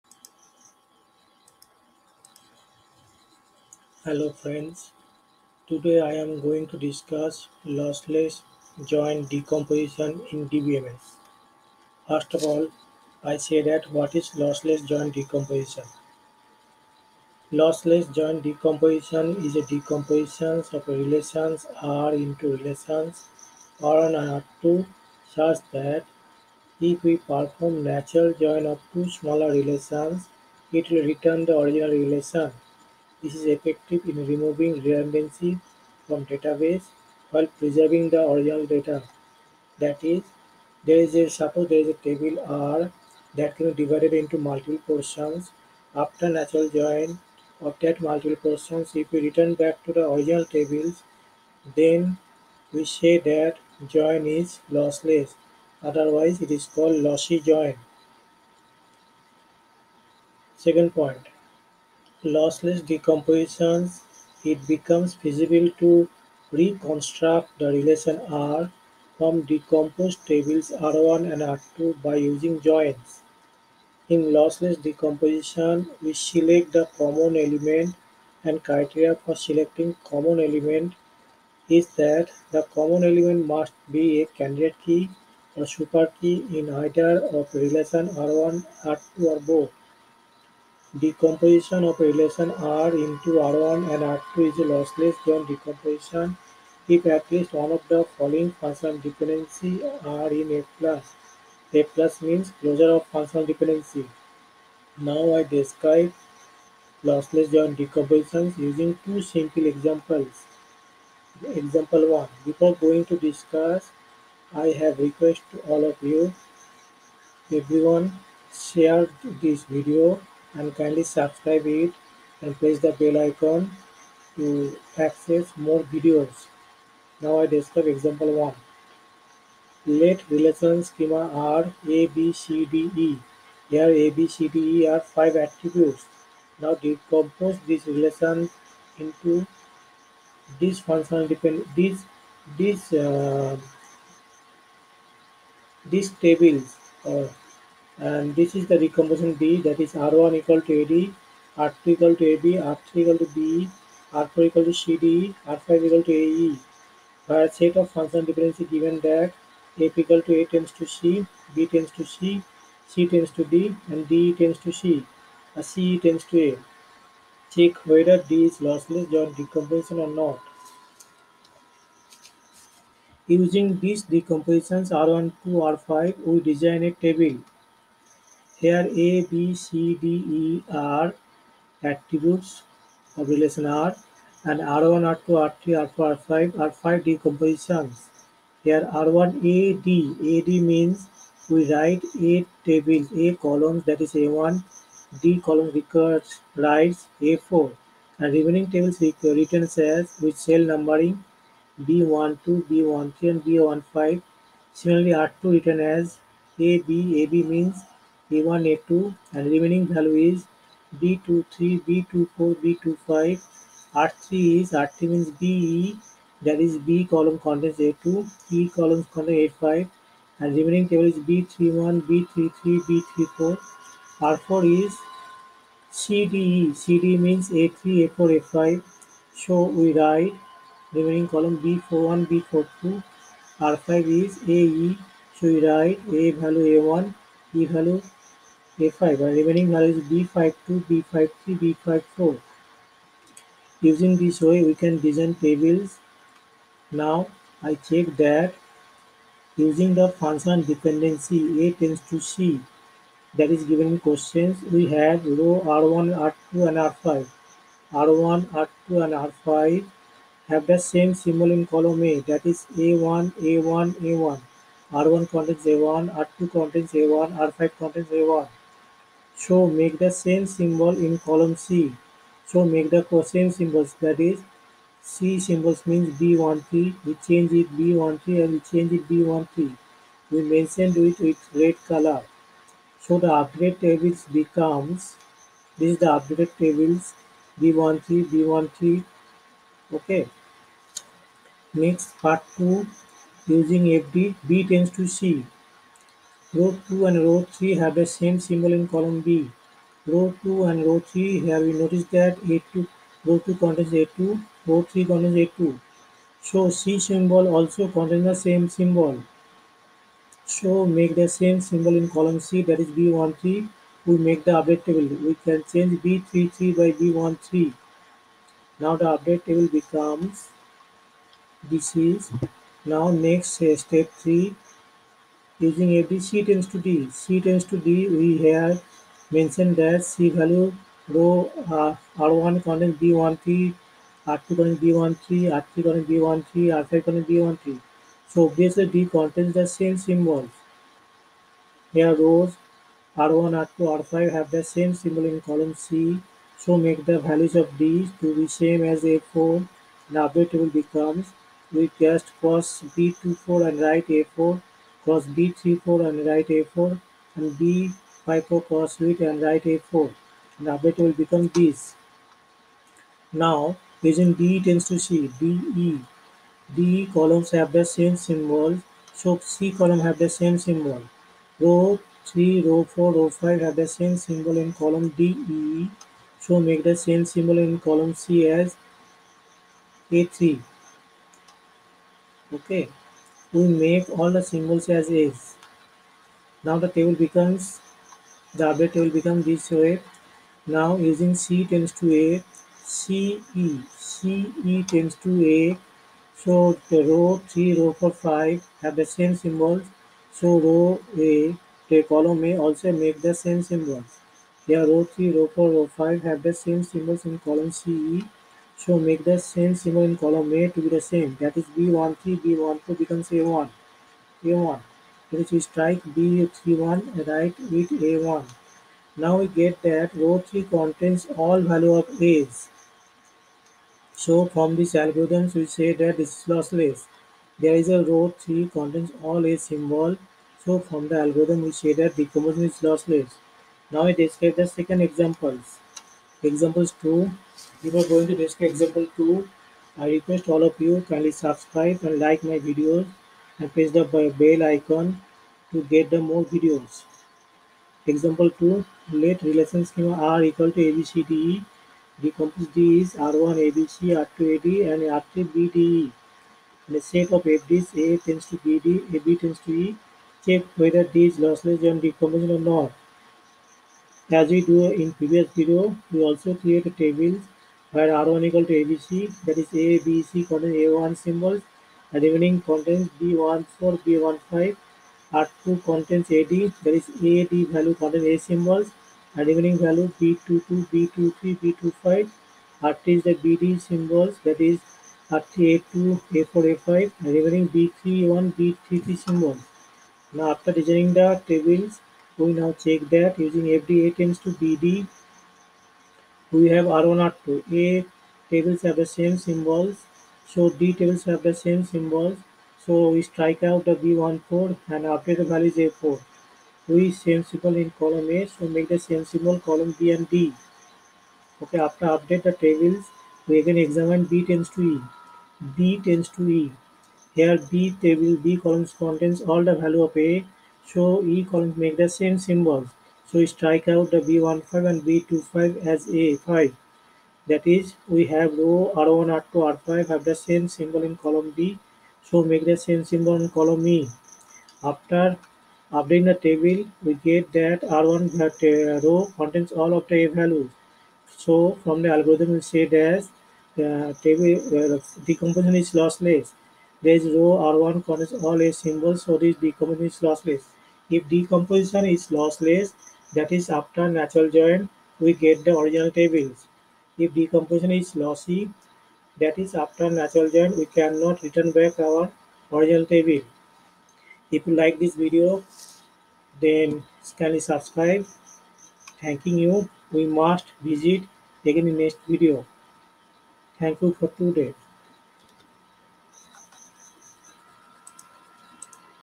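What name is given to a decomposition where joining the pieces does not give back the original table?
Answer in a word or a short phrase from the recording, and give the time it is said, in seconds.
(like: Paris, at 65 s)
lossy join, at 56 s.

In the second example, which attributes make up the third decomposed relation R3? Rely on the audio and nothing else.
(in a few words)
BDE.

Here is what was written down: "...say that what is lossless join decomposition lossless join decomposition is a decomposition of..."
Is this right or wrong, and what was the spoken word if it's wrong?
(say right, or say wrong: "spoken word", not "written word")
right.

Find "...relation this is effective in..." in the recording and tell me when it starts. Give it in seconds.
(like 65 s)
31 s.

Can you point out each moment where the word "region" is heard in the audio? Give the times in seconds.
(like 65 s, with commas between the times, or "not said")
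364 s.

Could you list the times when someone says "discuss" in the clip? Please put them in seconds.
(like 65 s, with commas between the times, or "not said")
6 s, 113 s, 438 s.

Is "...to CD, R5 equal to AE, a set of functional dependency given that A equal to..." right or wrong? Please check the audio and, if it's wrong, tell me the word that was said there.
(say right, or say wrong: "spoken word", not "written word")
right.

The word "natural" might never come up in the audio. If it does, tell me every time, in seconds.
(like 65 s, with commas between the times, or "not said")
27 s, 46 s, 554 s, 560 s.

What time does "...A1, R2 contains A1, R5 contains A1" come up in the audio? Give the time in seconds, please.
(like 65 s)
265 s.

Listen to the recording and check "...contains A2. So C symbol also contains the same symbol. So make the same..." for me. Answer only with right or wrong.
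right.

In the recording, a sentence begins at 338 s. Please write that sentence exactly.
So obviously D contains the same symbols.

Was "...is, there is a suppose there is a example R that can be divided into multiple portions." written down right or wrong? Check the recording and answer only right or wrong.
wrong.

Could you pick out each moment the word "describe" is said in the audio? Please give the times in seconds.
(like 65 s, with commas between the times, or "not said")
105 s, 127 s, 434 s.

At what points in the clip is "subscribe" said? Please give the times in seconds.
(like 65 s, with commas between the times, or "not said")
121 s, 441 s, 567 s.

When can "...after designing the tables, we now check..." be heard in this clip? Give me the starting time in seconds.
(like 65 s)
490 s.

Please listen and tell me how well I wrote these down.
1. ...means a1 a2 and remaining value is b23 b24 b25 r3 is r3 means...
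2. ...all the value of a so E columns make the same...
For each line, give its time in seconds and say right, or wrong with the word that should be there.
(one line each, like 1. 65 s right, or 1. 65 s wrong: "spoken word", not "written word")
1. 207 s right
2. 519 s right.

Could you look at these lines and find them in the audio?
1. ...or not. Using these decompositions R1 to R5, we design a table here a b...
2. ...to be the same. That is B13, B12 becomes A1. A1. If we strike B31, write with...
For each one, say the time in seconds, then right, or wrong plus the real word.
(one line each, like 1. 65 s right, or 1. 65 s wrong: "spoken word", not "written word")
1. 169 s right
2. 410 s right.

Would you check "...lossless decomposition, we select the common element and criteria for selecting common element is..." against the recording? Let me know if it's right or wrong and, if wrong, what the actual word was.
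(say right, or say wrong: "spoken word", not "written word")
right.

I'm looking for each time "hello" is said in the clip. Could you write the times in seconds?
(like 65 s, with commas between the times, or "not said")
4 s.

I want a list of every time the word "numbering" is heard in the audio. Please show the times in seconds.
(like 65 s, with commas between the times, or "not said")
200 s.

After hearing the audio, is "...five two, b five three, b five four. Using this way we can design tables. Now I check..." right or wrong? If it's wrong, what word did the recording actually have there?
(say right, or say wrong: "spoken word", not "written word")
right.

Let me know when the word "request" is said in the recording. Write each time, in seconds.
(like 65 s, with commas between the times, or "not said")
114 s, 440 s.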